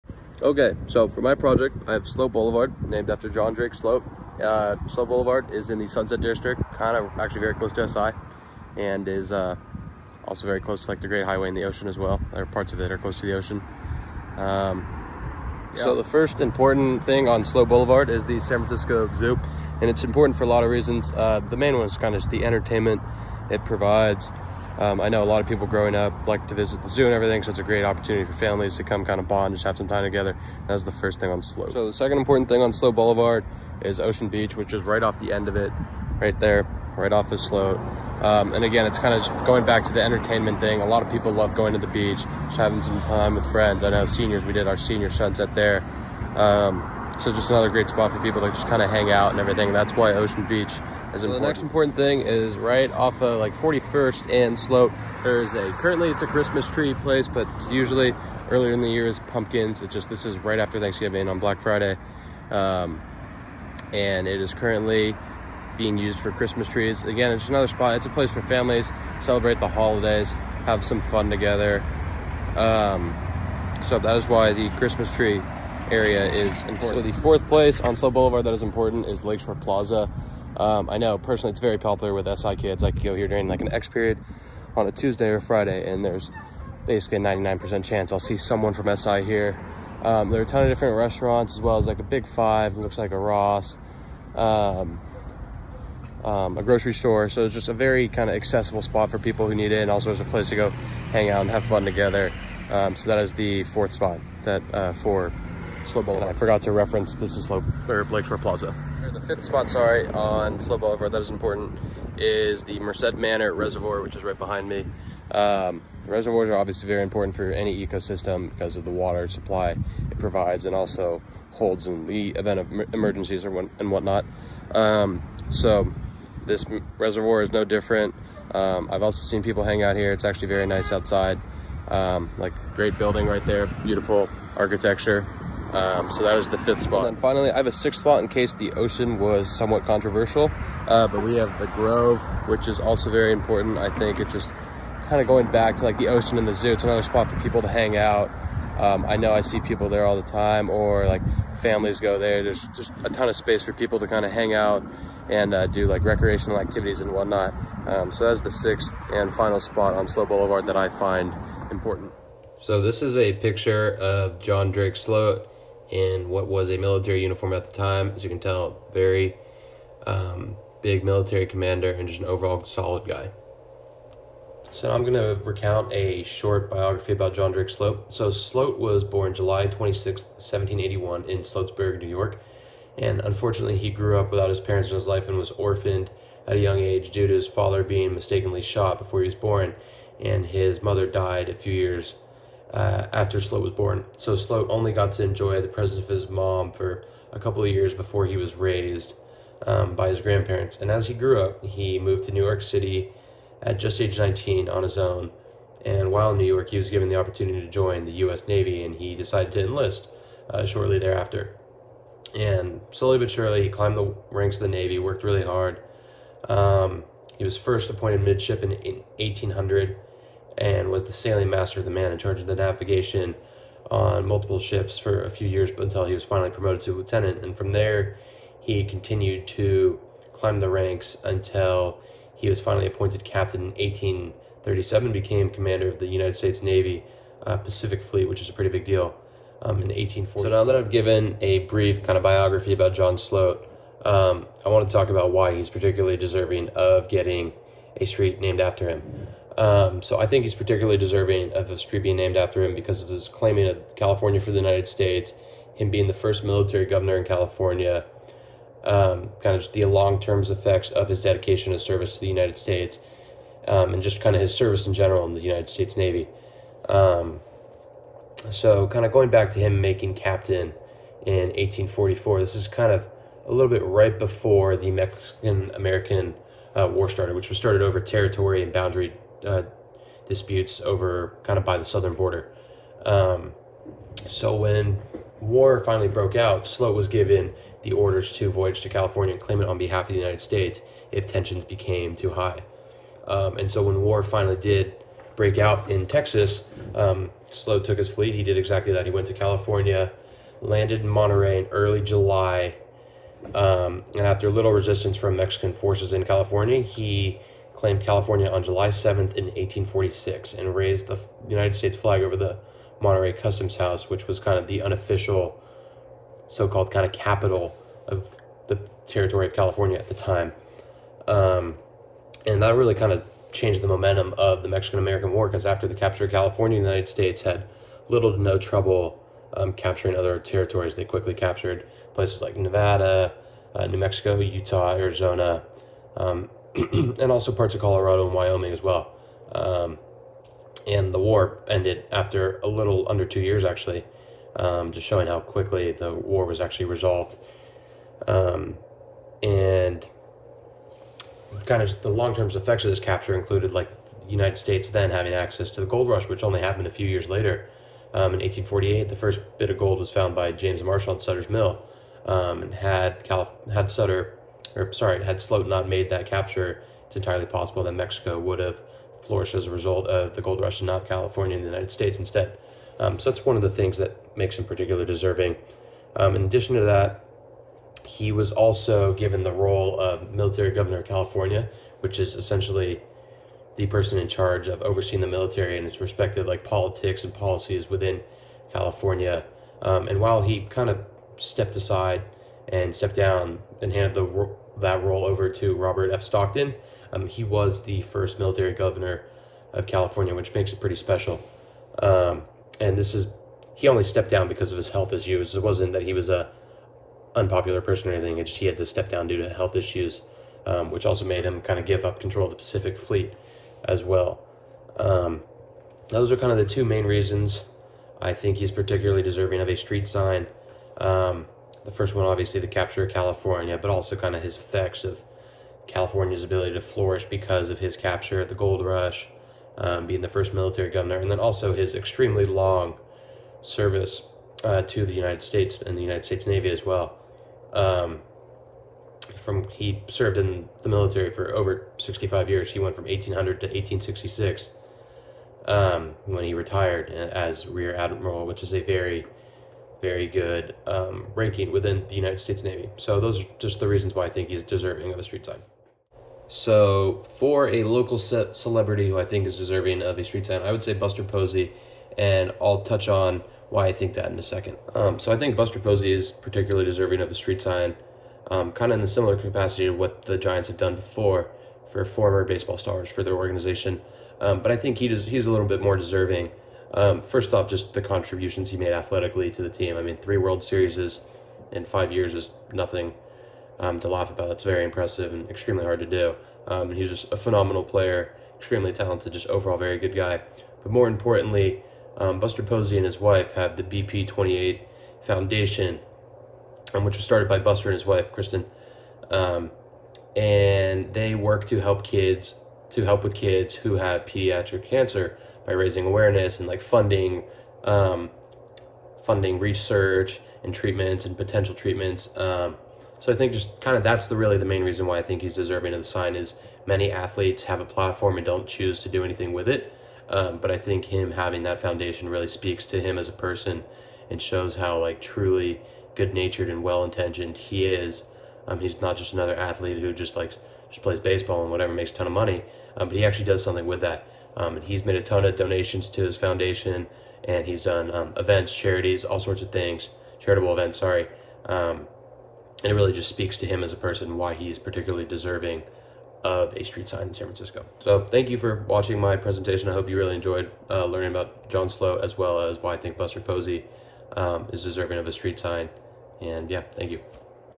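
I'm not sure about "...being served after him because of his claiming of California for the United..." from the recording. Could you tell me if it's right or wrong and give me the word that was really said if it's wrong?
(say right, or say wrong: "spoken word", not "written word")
wrong: "named", not "served".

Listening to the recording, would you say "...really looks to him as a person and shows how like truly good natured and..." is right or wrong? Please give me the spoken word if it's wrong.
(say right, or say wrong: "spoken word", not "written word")
wrong: "speaks", not "looks".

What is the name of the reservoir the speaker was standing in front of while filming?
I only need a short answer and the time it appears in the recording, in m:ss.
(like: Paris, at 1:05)
Merced Manor Reservoir, at 1:52.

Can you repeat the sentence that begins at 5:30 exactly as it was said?
They quickly captured places like Nevada, uh, New Mexico, Utah, Arizona.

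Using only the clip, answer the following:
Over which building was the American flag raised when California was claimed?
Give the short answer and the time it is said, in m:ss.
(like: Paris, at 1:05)
Monterey Customs House, at 5:13.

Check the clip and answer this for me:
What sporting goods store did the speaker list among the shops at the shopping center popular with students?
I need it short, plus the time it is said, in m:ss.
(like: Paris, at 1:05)
Big Five, at 1:32.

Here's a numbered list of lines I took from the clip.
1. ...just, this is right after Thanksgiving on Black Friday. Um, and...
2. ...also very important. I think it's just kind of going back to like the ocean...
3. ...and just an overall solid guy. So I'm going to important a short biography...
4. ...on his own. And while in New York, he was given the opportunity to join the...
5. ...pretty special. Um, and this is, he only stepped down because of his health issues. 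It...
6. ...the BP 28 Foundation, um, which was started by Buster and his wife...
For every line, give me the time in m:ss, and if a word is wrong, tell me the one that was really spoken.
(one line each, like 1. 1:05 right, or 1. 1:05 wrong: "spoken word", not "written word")
1. 0:59 right
2. 2:22 right
3. 2:51 wrong: "recount", not "important"
4. 3:24 right
5. 6:40 right
6. 8:13 right.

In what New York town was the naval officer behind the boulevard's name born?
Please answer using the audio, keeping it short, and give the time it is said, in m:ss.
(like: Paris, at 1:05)
Sloatsburg, at 3:01.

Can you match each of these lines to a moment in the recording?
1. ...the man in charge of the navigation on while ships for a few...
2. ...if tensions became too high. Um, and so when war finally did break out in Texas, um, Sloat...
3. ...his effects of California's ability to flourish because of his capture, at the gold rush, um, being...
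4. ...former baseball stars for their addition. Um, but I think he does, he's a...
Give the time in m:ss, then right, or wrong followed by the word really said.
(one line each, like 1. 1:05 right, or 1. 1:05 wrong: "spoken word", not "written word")
1. 3:41 wrong: "multiple", not "while"
2. 4:51 right
3. 7:04 right
4. 7:52 wrong: "organization", not "addition".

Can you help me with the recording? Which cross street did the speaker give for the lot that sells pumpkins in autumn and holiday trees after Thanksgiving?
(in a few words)
41st.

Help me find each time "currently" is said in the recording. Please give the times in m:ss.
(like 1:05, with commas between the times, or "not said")
0:55, 1:04.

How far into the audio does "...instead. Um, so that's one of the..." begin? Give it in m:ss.
6:12.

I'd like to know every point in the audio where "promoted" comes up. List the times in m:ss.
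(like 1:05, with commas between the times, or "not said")
3:46.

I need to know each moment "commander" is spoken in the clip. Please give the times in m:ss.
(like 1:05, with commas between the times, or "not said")
2:51, 3:55.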